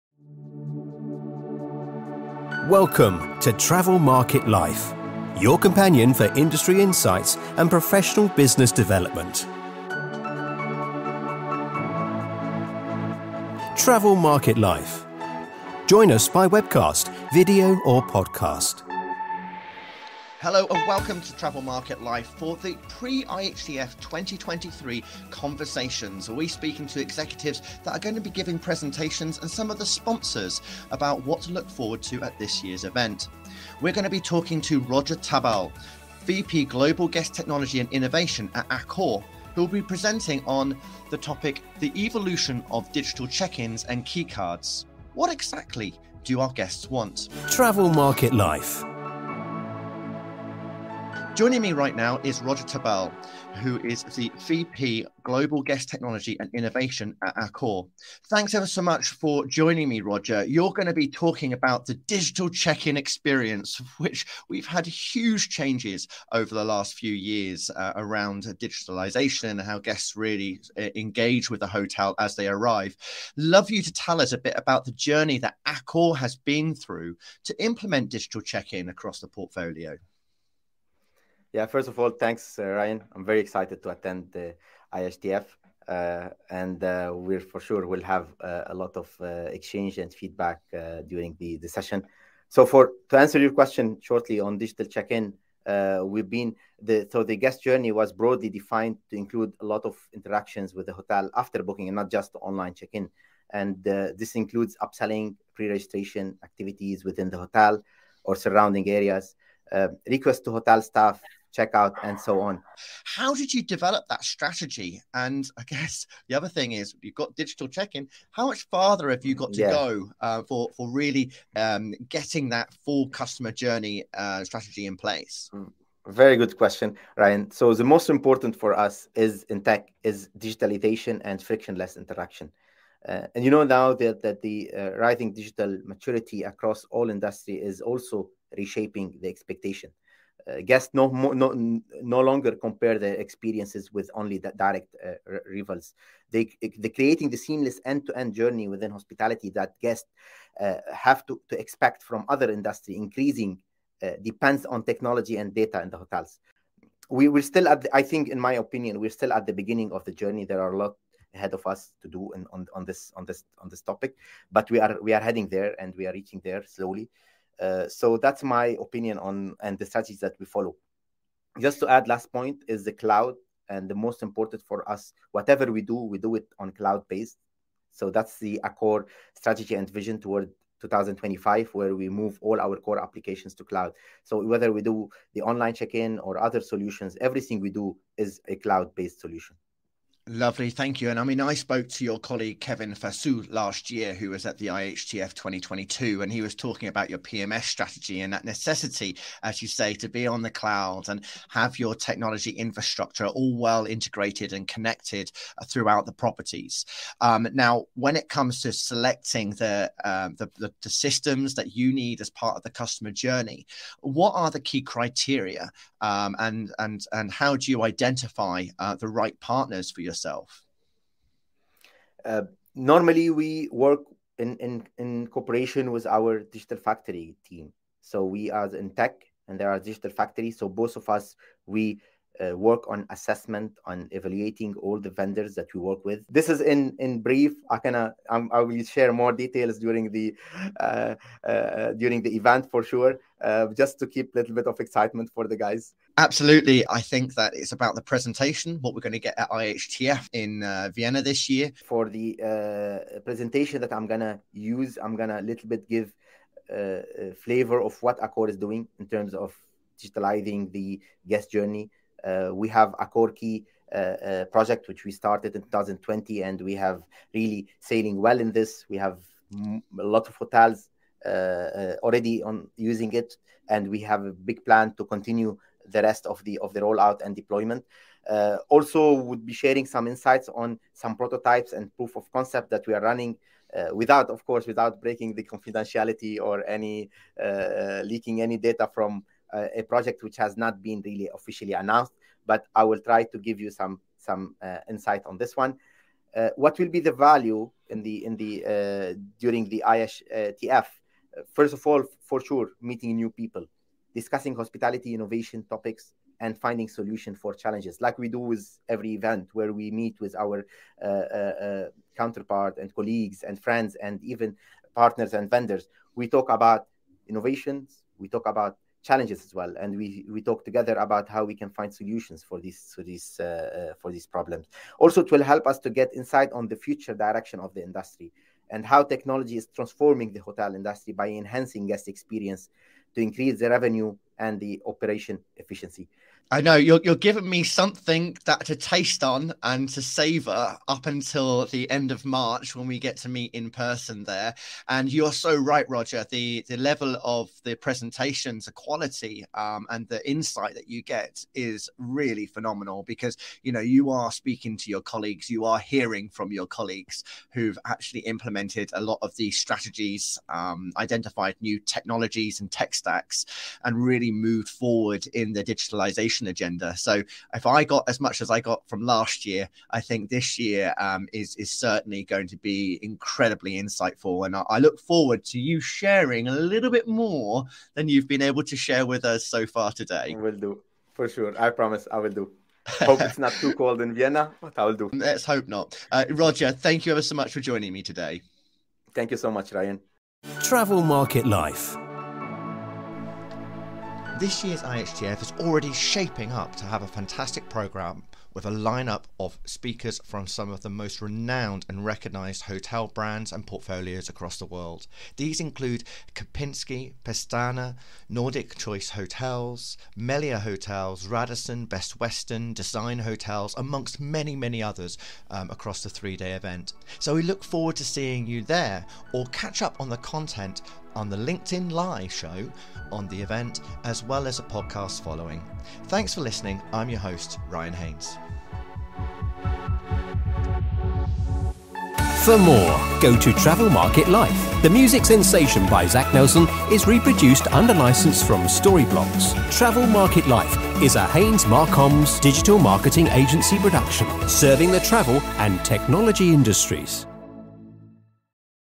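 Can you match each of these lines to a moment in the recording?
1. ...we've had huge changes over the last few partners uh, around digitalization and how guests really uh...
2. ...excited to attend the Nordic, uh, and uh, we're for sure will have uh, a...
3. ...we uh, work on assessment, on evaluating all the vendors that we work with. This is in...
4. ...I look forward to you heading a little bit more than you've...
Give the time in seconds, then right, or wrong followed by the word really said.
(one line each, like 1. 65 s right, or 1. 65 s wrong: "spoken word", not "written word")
1. 64 s wrong: "years", not "partners"
2. 83 s wrong: "IHTF", not "Nordic"
3. 231 s right
4. 374 s wrong: "sharing", not "heading".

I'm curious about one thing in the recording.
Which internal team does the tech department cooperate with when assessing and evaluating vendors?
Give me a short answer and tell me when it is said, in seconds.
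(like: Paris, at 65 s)
digital factory team, at 226 s.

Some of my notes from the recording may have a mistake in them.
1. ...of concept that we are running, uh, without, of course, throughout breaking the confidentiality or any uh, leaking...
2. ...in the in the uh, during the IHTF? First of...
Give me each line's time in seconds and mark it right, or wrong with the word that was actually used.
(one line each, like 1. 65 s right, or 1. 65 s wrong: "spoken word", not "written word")
1. 282 s wrong: "without", not "throughout"
2. 297 s right.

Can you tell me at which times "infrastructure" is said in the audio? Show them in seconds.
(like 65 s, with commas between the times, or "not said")
202 s.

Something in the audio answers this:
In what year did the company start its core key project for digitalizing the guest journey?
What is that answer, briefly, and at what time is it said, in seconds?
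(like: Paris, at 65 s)
2020, at 265 s.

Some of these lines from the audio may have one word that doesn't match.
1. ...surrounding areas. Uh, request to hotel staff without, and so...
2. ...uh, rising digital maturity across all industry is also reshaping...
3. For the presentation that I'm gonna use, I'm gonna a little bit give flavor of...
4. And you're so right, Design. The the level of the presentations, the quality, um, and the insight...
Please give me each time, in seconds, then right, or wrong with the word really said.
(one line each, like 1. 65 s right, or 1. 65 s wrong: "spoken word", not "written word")
1. 108 s wrong: "checkout", not "without"
2. 134 s right
3. 251 s right
4. 344 s wrong: "Roger", not "Design".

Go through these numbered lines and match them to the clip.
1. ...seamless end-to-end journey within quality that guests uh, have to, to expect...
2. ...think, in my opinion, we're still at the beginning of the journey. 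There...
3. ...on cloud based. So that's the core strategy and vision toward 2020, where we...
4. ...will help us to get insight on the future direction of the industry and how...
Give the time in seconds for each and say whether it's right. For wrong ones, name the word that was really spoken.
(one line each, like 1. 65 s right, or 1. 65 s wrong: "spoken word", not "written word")
1. 147 s wrong: "hospitality", not "quality"
2. 158 s right
3. 176 s wrong: "2025", not "2020"
4. 325 s right.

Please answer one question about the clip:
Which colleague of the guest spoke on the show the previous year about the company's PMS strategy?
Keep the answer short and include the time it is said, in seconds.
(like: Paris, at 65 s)
Kevin Fassou, at 192 s.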